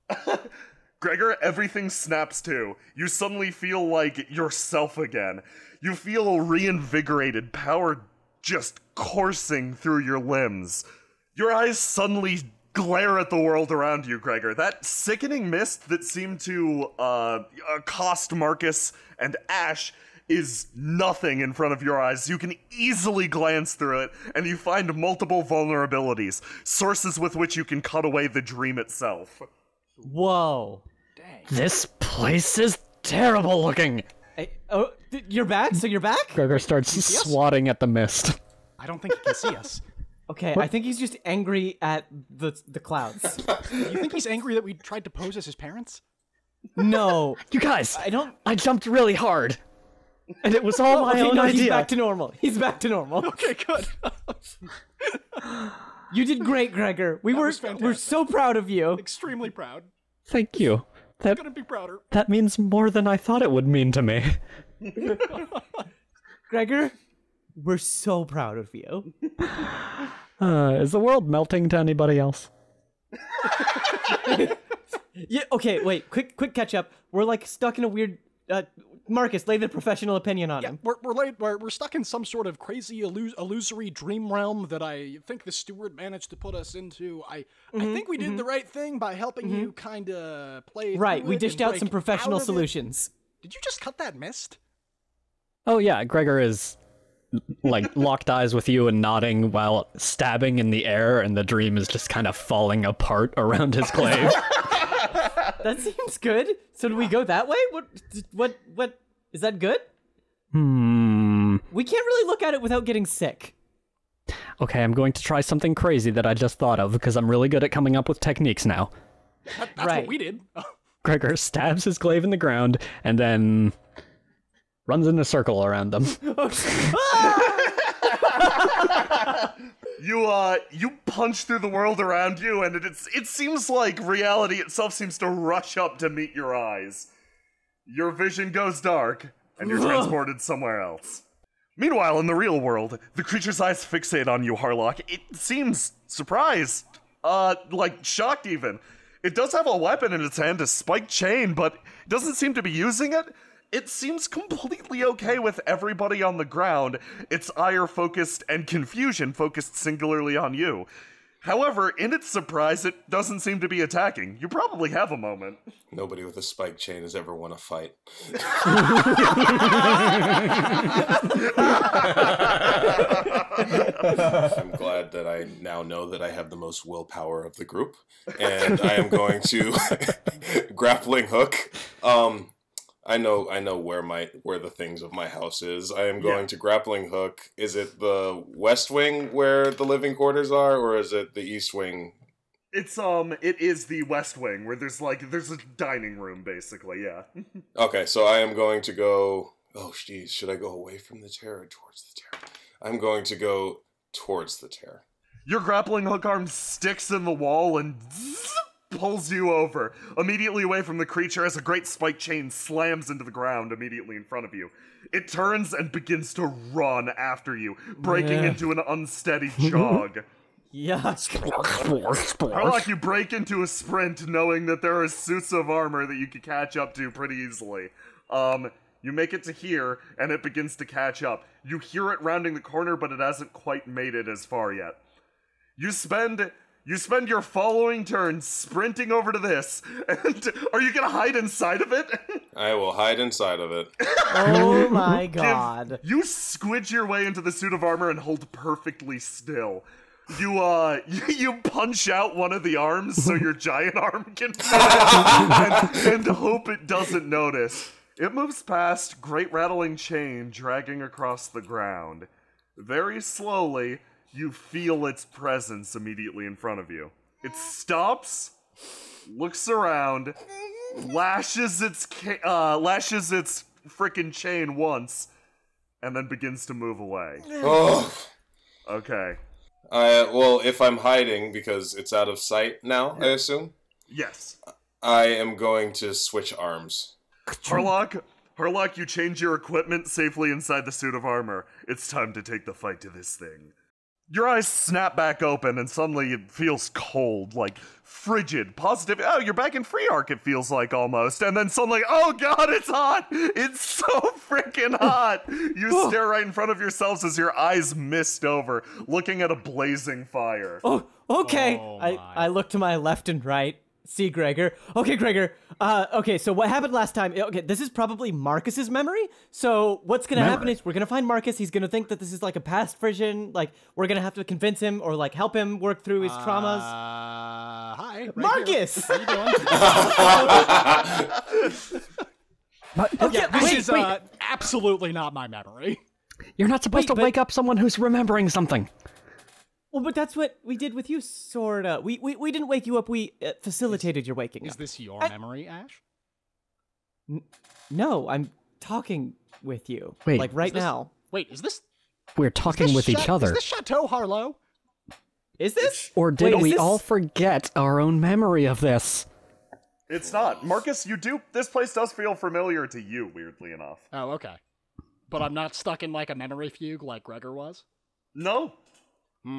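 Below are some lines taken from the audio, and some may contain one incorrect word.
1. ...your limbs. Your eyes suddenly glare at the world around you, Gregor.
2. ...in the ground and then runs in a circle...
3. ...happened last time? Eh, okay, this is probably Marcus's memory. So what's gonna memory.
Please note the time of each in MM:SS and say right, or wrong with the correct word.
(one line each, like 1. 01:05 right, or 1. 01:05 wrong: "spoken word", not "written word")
1. 00:10 right
2. 02:02 right
3. 05:16 right.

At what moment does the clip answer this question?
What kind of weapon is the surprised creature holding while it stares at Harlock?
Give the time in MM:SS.
02:30.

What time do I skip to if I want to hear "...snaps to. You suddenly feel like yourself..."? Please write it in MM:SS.
00:01.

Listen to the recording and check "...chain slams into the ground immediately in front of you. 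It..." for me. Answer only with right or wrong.
right.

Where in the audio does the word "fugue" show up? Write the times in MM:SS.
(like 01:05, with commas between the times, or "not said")
06:06.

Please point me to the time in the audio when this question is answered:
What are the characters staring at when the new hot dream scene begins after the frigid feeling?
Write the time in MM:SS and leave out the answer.
05:09.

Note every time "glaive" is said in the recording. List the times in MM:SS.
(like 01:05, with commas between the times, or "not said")
01:43, 02:01.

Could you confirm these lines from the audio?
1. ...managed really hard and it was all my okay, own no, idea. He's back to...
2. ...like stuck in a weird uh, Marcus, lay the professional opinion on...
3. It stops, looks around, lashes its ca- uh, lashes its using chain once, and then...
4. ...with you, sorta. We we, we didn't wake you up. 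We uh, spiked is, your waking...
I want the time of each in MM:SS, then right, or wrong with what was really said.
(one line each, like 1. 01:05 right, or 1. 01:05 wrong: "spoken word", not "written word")
1. 00:48 wrong: "jumped", not "managed"
2. 01:17 right
3. 04:27 wrong: "freaking", not "using"
4. 05:40 wrong: "facilitated", not "spiked".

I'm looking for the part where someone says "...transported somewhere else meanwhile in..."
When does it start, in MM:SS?
02:19.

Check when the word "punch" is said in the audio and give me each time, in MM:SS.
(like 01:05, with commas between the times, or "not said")
02:11, 04:11.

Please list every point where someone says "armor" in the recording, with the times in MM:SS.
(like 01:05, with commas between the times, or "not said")
03:45, 04:07, 04:51.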